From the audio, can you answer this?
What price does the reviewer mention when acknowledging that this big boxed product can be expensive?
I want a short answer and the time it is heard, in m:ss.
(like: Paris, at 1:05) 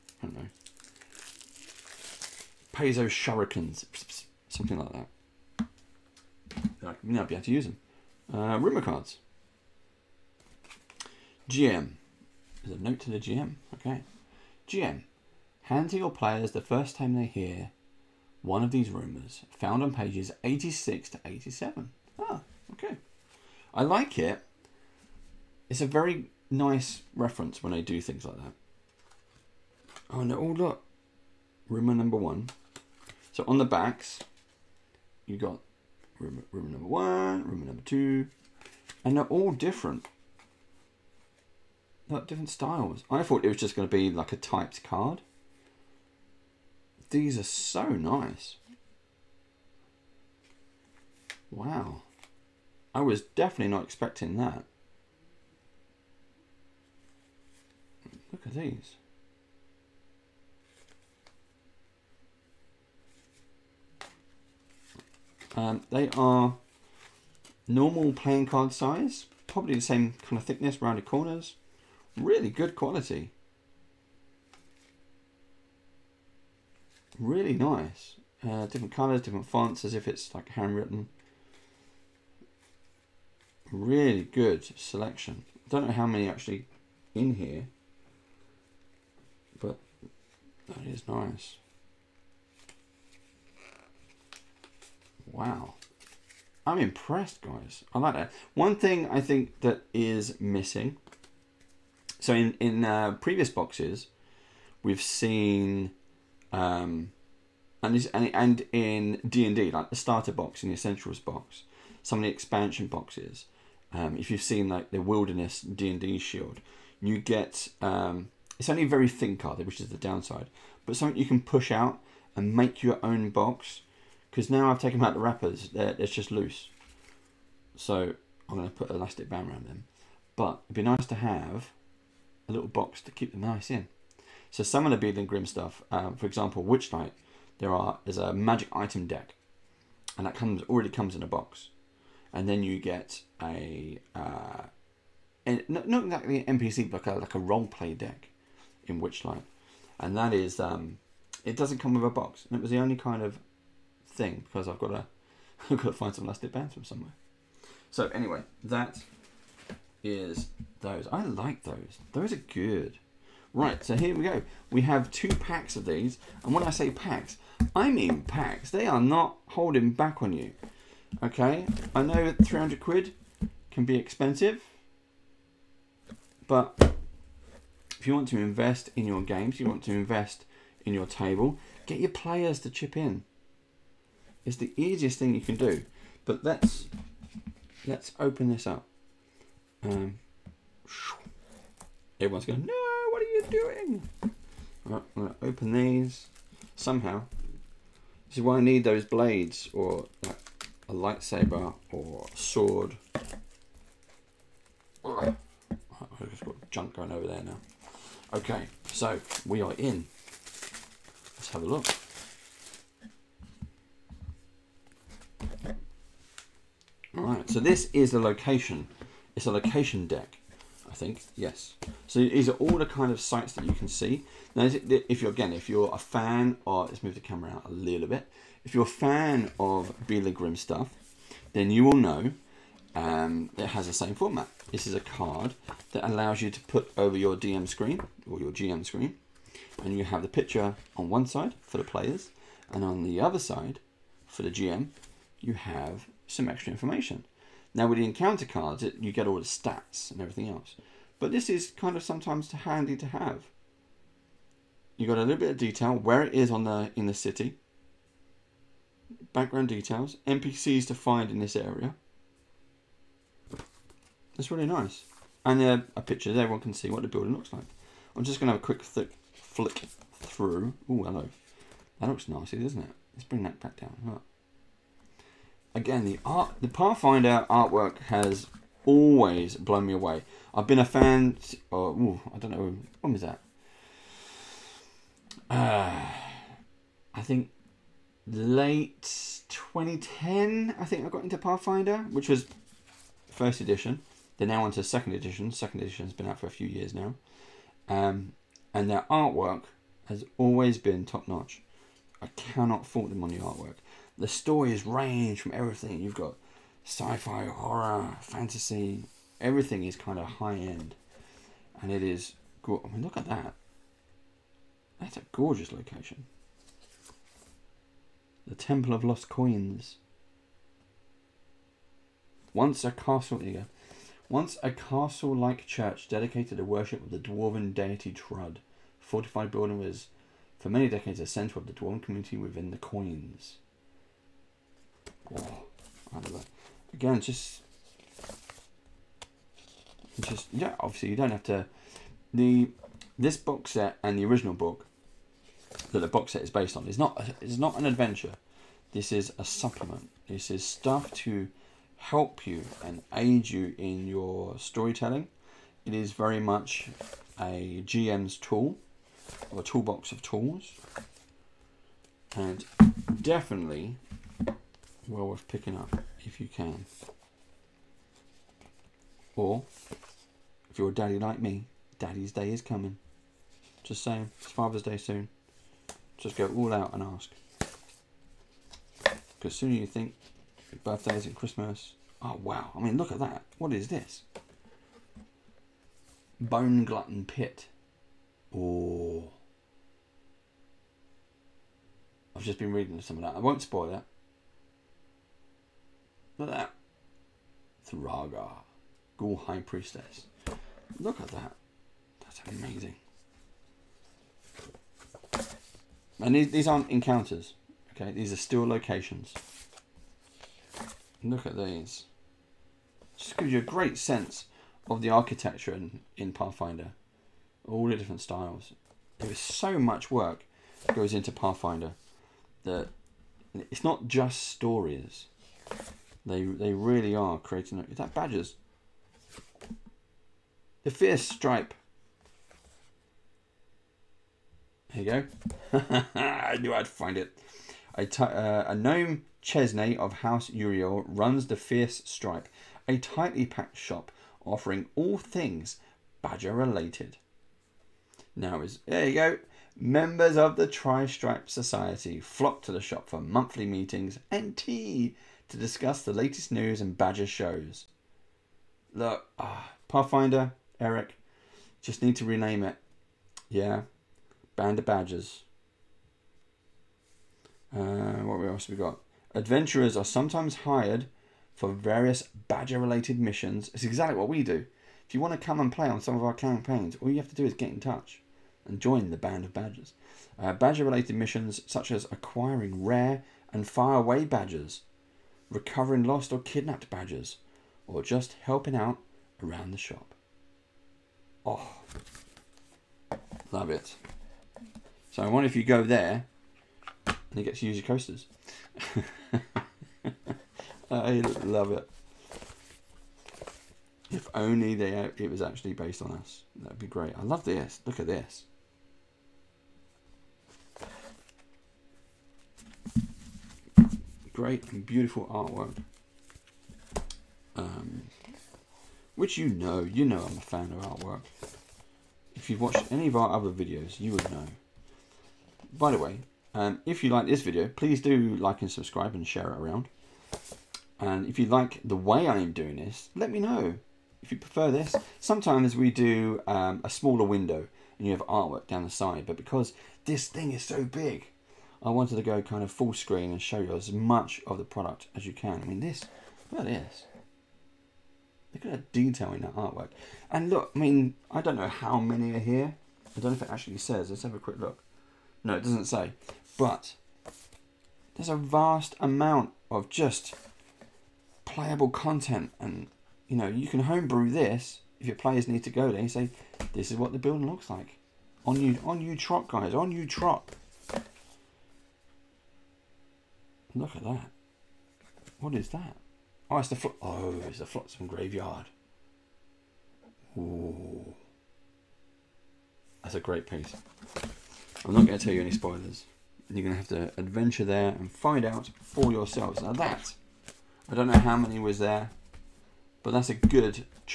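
300 quid, at 2:52.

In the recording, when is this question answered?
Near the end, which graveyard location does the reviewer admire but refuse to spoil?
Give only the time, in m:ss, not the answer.
9:37.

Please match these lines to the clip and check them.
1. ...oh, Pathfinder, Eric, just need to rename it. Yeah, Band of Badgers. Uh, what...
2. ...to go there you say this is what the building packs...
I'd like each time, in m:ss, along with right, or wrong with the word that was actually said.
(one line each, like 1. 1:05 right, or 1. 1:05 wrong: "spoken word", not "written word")
1. 7:39 right
2. 9:25 wrong: "looks", not "packs".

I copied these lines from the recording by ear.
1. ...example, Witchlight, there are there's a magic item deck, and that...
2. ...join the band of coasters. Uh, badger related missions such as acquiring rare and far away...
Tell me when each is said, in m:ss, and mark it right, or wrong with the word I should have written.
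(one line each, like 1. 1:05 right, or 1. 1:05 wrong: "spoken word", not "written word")
1. 2:16 right
2. 7:58 wrong: "badgers", not "coasters".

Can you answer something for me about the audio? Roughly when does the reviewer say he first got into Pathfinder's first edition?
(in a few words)
late 2010.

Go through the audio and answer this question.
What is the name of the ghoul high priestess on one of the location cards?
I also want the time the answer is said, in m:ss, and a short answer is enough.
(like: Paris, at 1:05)
Thraga, at 6:37.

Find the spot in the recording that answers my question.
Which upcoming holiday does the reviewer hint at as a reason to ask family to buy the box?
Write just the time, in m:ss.
6:14.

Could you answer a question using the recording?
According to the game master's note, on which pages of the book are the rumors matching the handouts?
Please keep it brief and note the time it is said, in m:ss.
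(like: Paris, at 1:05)
86 to 87, at 0:19.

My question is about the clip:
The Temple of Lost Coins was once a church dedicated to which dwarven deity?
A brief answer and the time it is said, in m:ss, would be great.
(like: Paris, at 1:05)
Trud, at 5:28.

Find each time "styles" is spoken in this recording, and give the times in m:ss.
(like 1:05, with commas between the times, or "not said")
0:42, 6:58.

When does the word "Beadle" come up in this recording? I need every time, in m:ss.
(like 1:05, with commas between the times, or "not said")
2:14, 3:50.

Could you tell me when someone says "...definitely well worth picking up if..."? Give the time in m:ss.
6:03.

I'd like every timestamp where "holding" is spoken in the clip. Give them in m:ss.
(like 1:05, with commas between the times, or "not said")
2:49.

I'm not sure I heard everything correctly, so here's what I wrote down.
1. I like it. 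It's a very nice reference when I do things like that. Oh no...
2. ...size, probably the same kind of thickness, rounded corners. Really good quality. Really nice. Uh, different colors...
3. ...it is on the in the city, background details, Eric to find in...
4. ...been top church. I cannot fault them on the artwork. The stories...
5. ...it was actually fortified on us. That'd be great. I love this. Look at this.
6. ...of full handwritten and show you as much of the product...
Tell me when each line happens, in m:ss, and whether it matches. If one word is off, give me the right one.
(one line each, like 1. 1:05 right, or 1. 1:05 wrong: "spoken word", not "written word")
1. 0:23 right
2. 1:08 right
3. 4:16 wrong: "NPCs", not "Eric"
4. 5:00 wrong: "notch", not "church"
5. 8:25 wrong: "based", not "fortified"
6. 9:02 wrong: "screen", not "handwritten".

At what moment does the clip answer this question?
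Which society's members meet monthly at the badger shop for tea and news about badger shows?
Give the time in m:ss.
7:30.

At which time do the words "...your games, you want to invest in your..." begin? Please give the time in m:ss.
2:59.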